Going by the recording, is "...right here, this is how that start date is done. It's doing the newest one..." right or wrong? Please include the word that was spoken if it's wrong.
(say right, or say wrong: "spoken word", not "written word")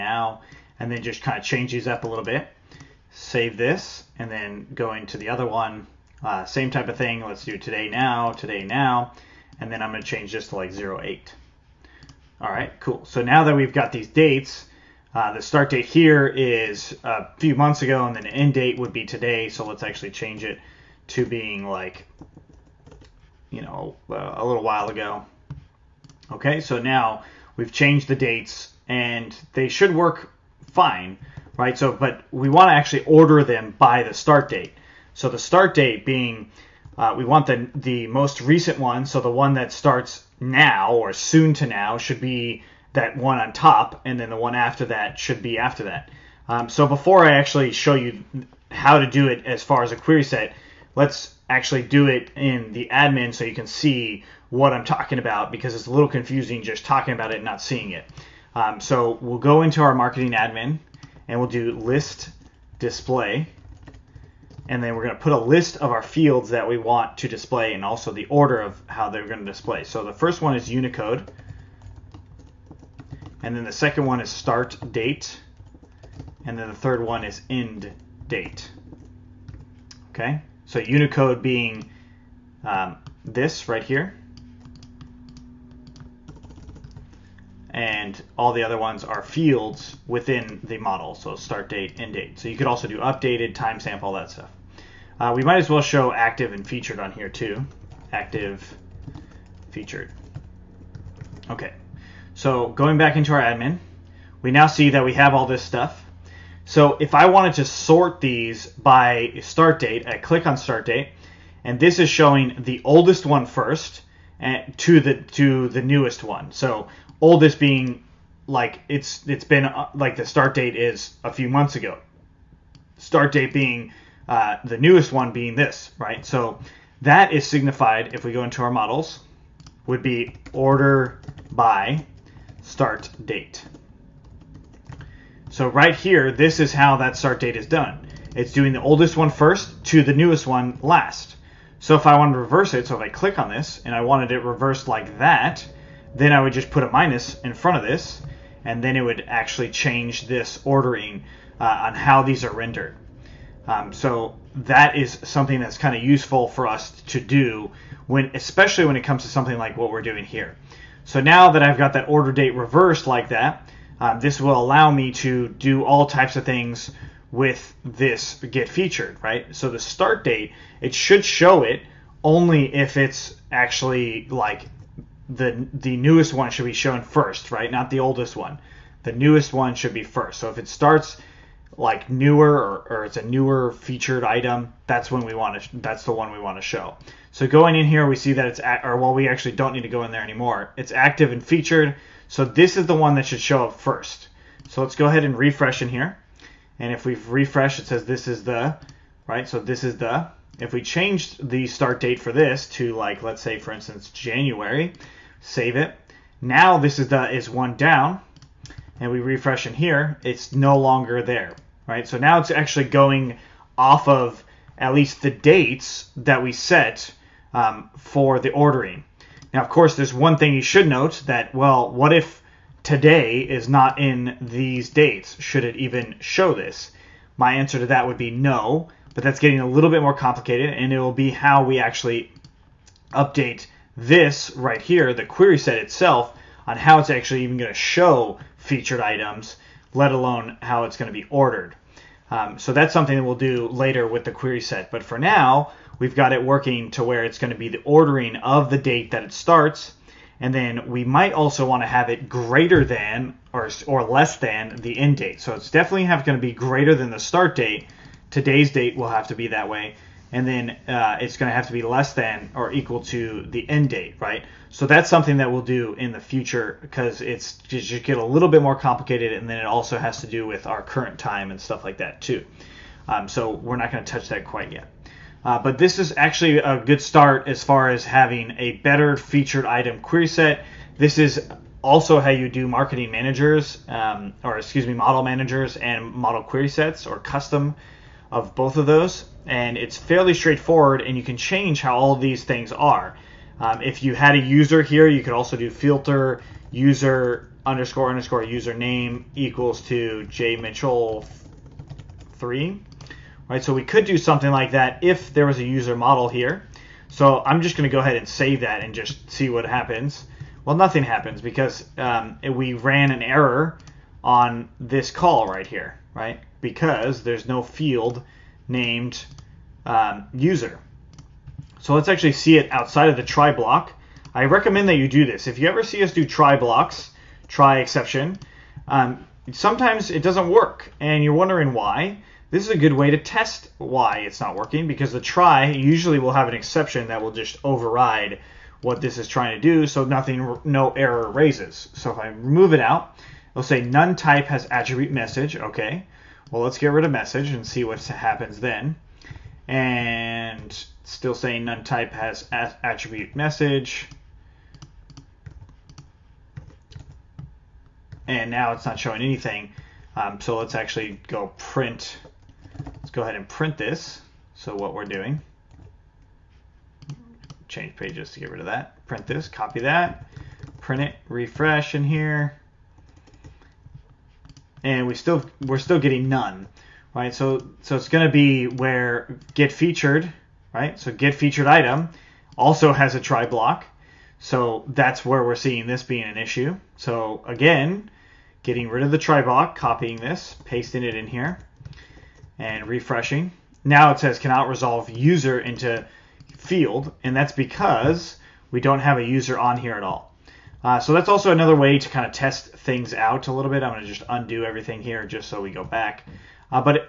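wrong: "oldest", not "newest".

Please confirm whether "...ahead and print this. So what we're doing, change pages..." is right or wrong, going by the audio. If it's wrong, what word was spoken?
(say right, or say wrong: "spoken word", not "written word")
right.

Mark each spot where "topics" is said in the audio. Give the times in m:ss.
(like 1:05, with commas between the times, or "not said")
not said.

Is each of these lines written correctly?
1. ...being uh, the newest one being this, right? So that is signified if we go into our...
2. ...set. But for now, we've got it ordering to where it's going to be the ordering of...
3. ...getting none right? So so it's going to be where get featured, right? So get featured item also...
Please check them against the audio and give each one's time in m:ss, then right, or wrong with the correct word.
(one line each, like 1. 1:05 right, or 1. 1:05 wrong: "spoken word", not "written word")
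1. 2:03 right
2. 4:04 wrong: "working", not "ordering"
3. 6:15 right.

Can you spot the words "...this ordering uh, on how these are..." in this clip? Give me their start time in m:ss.
2:30.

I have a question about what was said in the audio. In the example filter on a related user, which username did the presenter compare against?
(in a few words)
J Mitchell three.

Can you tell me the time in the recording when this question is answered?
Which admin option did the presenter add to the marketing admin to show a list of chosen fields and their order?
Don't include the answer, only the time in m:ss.
1:01.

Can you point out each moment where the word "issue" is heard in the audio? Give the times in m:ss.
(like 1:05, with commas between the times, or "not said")
6:26.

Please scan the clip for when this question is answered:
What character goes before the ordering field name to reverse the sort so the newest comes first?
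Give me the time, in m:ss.
2:26.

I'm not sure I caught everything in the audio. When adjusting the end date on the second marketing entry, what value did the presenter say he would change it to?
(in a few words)
08.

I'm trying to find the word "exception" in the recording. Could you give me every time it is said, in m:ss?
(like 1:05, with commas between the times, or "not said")
5:27, 5:36.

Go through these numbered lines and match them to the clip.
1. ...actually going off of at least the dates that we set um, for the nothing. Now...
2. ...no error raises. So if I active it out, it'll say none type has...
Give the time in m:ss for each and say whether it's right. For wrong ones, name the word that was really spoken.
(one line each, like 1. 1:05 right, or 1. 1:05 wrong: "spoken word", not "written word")
1. 3:32 wrong: "ordering", not "nothing"
2. 5:40 wrong: "remove", not "active".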